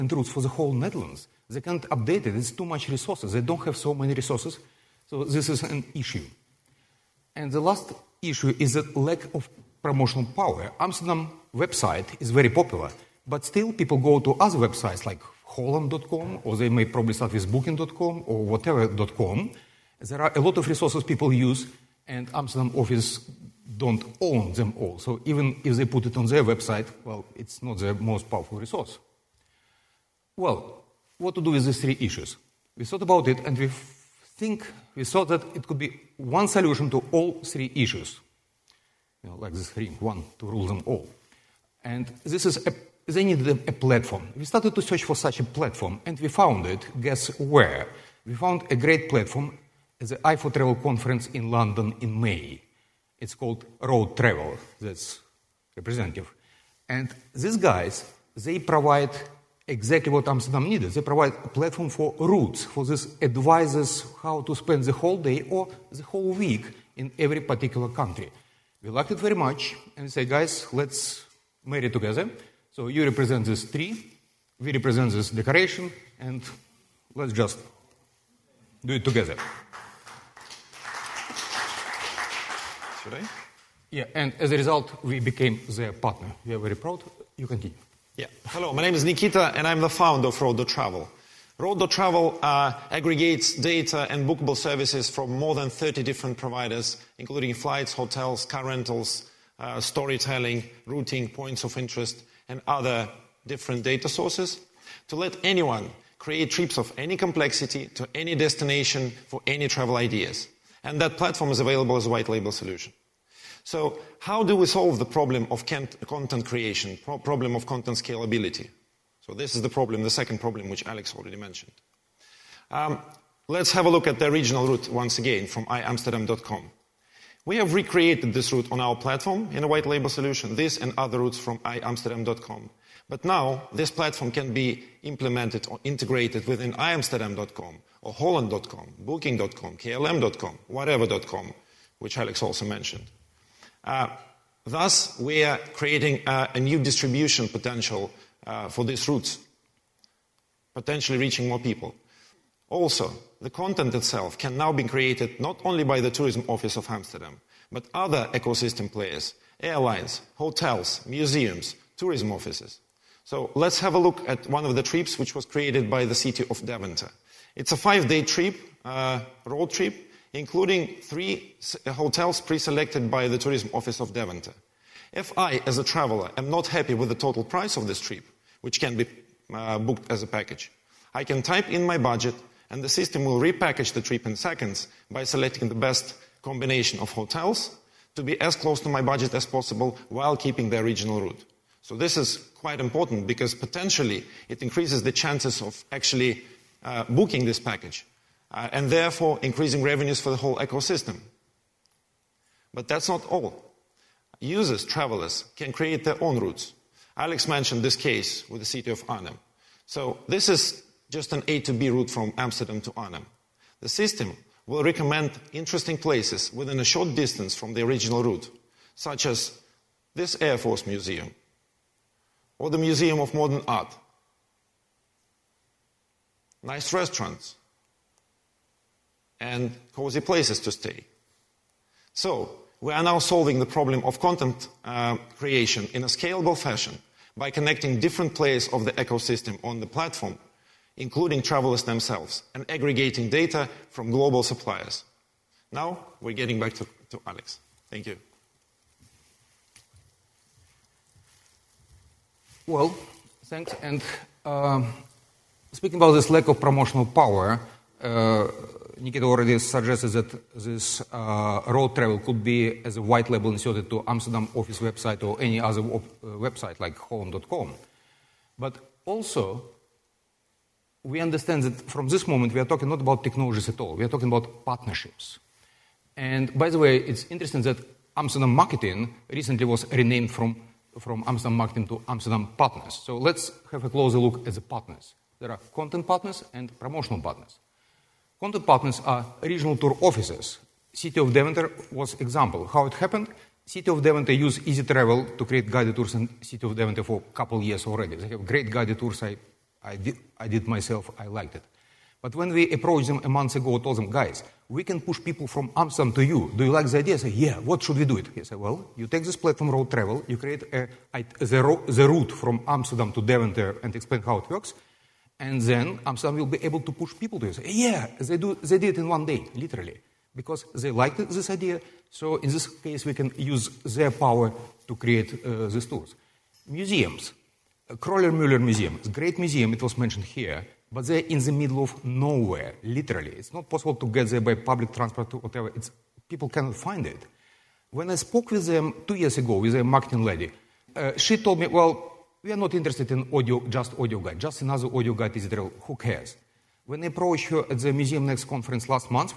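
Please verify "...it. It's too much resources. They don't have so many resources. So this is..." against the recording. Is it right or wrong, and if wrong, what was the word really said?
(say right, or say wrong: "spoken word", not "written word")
right.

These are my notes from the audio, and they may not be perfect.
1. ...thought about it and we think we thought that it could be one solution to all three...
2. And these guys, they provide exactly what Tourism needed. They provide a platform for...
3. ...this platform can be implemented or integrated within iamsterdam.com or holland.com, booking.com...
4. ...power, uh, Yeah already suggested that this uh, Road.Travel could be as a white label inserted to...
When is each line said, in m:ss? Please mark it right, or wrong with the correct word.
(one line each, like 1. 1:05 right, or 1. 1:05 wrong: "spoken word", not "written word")
1. 0:32 right
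2. 0:56 wrong: "Amsterdam", not "Tourism"
3. 2:13 right
4. 4:17 wrong: "Nikita", not "Yeah".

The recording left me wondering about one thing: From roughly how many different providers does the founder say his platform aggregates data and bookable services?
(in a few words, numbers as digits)
more than 30.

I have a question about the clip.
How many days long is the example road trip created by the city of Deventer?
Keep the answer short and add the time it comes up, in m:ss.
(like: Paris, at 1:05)
5, at 2:47.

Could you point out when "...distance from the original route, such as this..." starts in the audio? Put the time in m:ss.
3:37.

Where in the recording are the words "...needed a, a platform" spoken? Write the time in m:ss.
0:43.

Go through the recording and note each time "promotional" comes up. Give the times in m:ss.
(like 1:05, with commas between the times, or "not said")
0:09, 4:16, 4:46.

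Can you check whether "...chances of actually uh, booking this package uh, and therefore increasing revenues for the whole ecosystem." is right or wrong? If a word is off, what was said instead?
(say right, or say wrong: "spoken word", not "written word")
right.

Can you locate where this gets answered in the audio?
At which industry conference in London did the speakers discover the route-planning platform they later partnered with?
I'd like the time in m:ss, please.
0:50.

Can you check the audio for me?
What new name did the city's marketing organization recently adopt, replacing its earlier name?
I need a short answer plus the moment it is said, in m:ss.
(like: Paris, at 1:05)
Amsterdam Partners, at 4:42.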